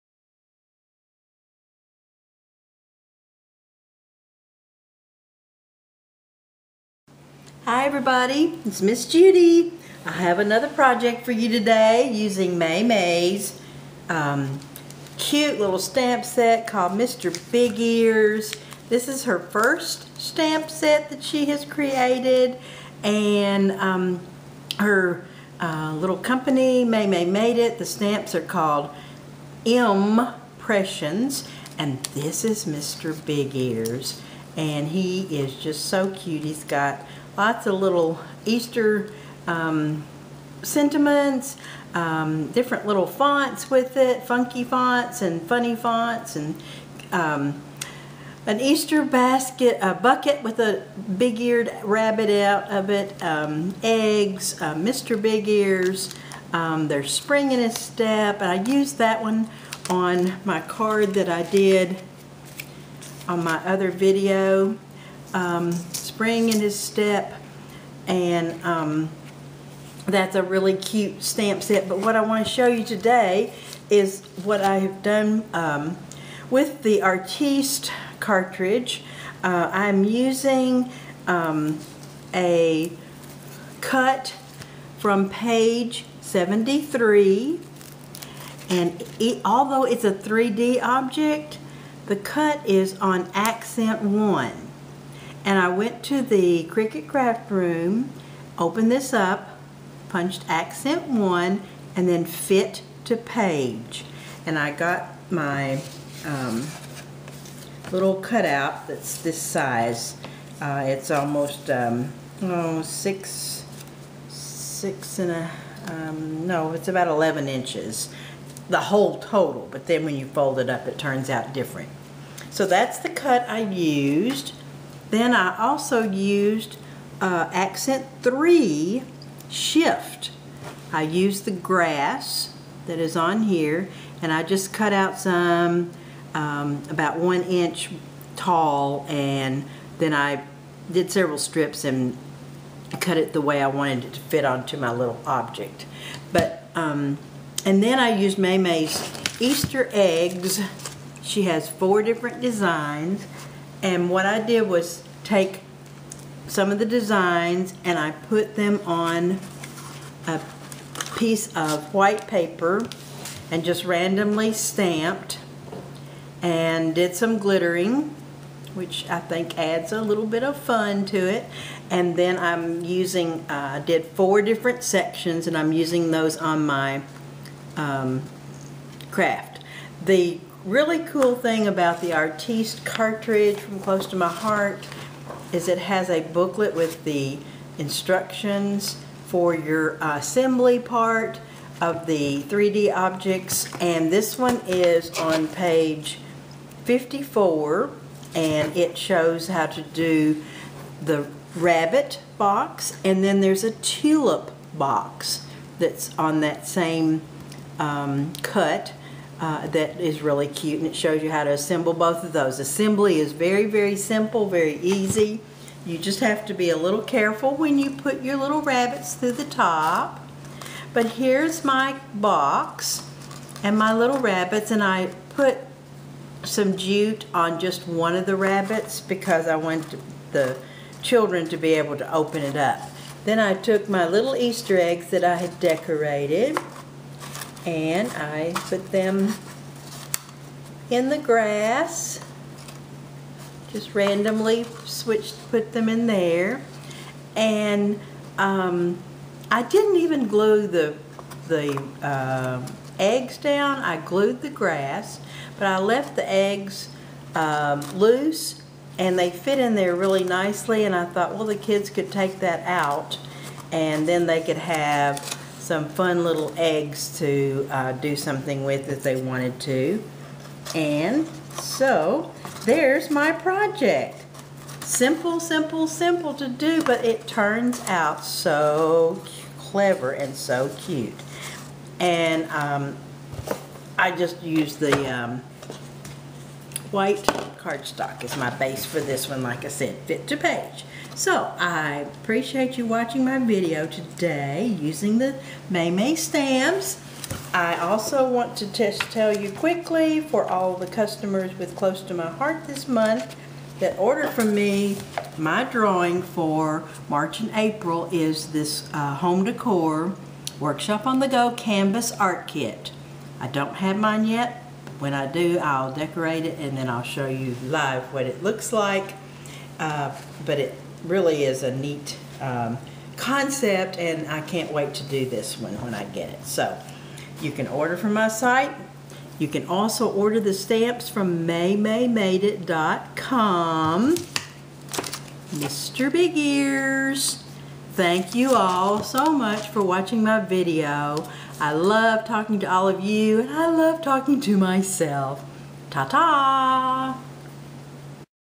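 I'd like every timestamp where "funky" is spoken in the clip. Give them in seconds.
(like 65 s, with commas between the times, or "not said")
44 s.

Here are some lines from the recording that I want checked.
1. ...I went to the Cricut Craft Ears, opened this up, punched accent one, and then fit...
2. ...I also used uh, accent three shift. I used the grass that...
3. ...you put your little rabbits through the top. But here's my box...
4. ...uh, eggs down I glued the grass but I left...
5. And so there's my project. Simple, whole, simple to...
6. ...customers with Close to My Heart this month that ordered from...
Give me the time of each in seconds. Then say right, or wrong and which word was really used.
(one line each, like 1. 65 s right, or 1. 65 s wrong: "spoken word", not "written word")
1. 95 s wrong: "Room", not "Ears"
2. 125 s right
3. 217 s right
4. 252 s right
5. 270 s wrong: "simple", not "whole"
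6. 300 s right.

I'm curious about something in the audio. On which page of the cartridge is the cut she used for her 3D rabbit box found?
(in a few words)
73.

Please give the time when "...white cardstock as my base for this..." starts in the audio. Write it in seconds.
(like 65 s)
286 s.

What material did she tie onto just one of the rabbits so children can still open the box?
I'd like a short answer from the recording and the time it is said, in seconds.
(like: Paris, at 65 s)
jute, at 226 s.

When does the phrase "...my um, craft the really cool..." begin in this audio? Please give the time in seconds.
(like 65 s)
176 s.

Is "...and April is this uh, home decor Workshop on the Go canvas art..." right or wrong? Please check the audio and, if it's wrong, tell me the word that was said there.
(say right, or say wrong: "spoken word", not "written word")
right.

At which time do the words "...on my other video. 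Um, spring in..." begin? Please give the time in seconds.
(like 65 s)
63 s.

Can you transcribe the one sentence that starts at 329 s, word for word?
You can also order the stamps from maymaymadeit.com.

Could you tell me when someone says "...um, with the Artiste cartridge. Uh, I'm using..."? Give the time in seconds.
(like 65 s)
75 s.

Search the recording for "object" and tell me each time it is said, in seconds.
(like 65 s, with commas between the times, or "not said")
90 s, 145 s, 192 s.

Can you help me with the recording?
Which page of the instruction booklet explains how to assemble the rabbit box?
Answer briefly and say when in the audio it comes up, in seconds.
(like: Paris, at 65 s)
54, at 195 s.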